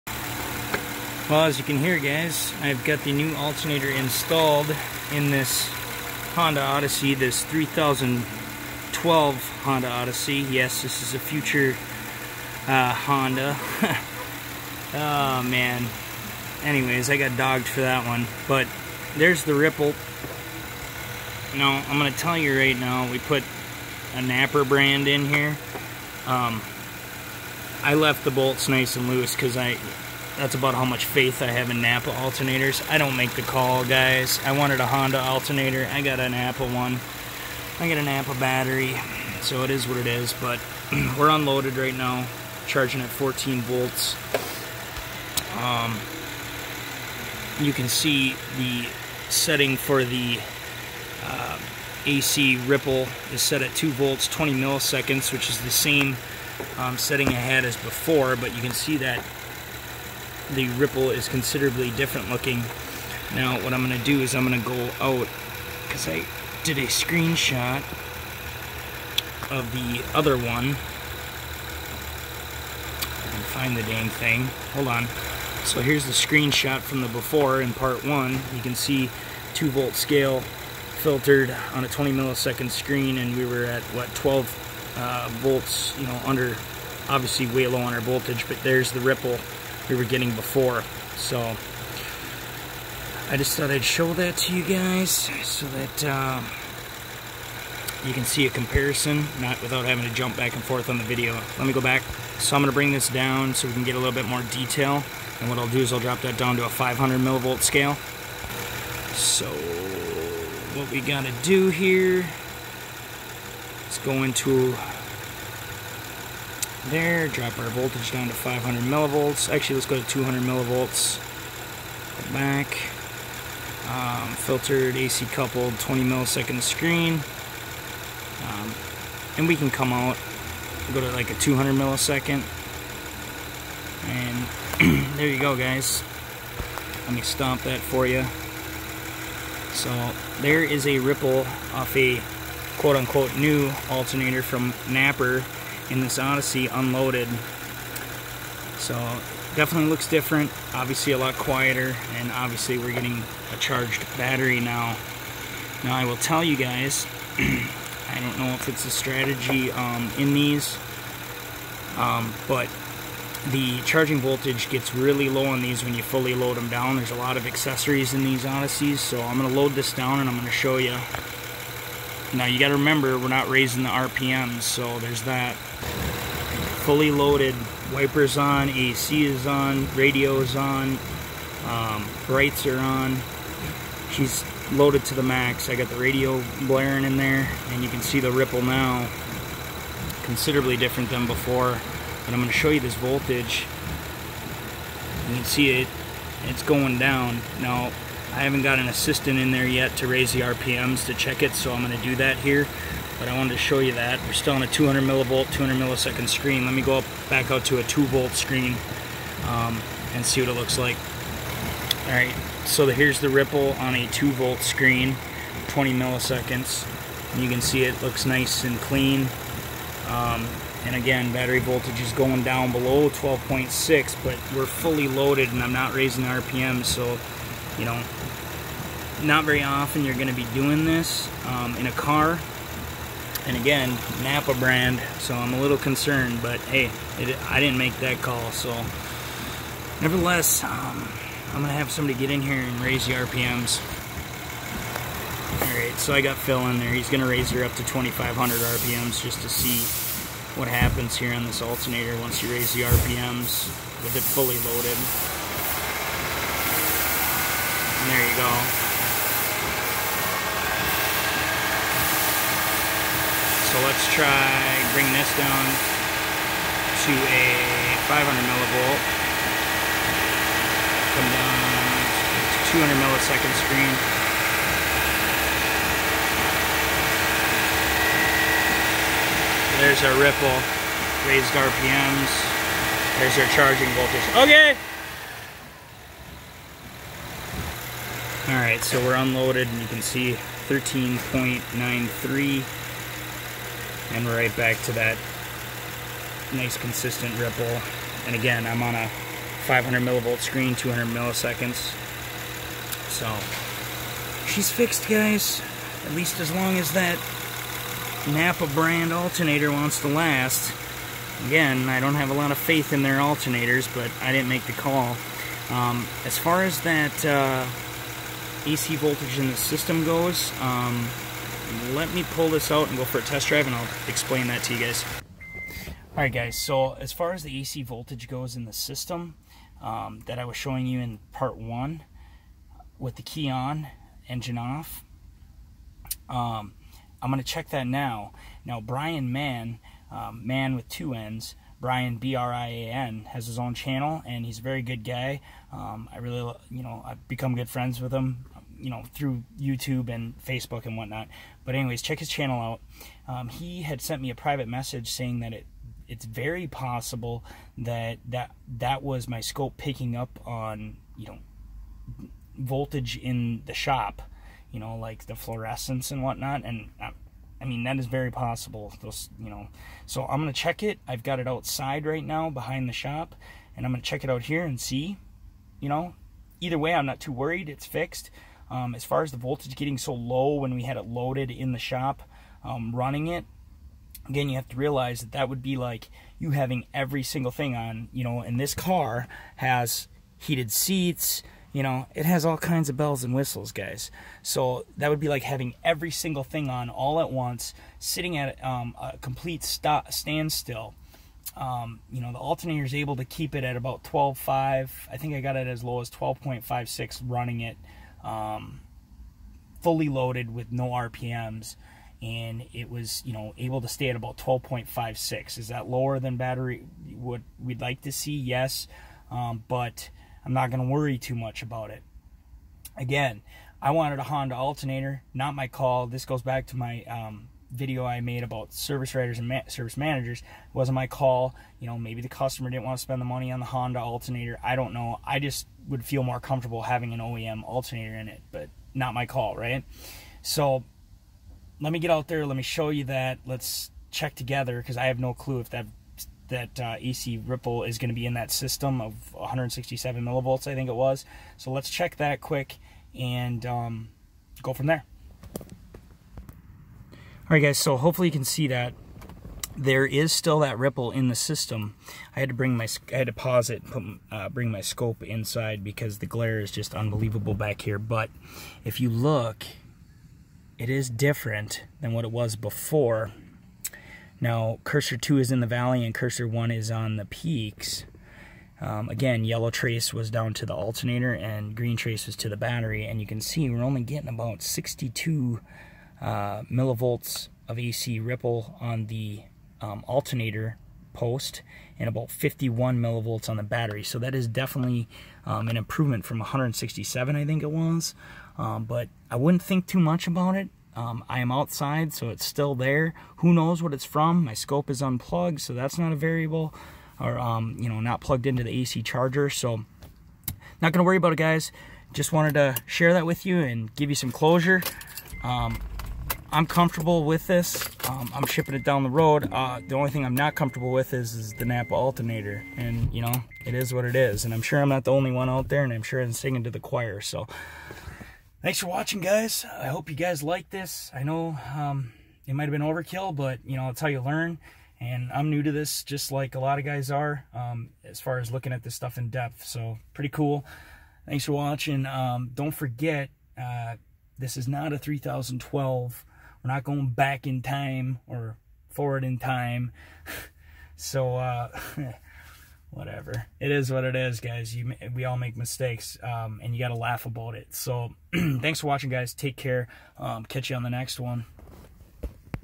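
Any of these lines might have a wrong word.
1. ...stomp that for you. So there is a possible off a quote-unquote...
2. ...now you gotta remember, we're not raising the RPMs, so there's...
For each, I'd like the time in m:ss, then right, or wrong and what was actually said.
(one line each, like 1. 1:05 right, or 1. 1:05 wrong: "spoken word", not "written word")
1. 2:17 wrong: "ripple", not "possible"
2. 2:52 right.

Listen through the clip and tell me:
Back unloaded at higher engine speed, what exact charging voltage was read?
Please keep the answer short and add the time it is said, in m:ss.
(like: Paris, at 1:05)
13.93, at 4:50.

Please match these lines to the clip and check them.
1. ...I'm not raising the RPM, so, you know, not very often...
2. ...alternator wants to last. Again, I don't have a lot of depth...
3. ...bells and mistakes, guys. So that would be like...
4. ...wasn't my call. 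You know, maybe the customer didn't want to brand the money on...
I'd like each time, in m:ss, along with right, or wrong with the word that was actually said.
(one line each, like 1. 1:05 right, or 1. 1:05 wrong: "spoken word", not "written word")
1. 3:45 right
2. 5:09 wrong: "faith", not "depth"
3. 6:32 wrong: "whistles", not "mistakes"
4. 7:10 wrong: "spend", not "brand".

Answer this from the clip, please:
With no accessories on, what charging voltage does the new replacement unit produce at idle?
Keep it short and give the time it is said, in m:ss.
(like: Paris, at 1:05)
14 volts, at 0:42.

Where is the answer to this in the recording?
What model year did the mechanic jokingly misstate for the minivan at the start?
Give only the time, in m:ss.
0:07.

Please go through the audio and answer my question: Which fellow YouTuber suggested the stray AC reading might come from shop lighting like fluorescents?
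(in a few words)
Brian Mann.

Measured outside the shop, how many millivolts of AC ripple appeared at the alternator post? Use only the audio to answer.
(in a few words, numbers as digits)
62 millivolts.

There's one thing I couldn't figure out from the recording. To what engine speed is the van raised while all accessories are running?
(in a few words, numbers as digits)
2,500 RPM.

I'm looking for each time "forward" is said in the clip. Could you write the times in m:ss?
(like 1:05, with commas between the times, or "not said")
9:08.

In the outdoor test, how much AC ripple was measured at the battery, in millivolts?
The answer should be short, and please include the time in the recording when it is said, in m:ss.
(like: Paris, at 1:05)
51 millivolts, at 8:12.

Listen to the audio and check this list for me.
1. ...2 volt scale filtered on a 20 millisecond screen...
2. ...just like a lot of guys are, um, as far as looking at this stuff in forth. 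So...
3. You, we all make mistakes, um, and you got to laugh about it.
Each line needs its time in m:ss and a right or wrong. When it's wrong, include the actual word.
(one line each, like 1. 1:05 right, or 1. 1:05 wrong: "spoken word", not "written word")
1. 1:19 right
2. 8:56 wrong: "depth", not "forth"
3. 9:14 right.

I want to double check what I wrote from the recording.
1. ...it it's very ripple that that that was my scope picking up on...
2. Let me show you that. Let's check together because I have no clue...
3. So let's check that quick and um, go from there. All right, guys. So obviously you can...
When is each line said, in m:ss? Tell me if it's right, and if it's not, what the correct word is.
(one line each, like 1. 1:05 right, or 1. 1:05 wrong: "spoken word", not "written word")
1. 5:55 wrong: "possible", not "ripple"
2. 7:22 right
3. 7:31 wrong: "hopefully", not "obviously".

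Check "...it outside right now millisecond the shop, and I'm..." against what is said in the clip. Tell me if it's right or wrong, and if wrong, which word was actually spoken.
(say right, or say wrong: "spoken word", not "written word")
wrong: "behind", not "millisecond".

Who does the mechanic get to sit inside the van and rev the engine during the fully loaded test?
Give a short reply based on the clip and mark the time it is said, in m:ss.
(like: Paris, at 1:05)
Phil, at 4:06.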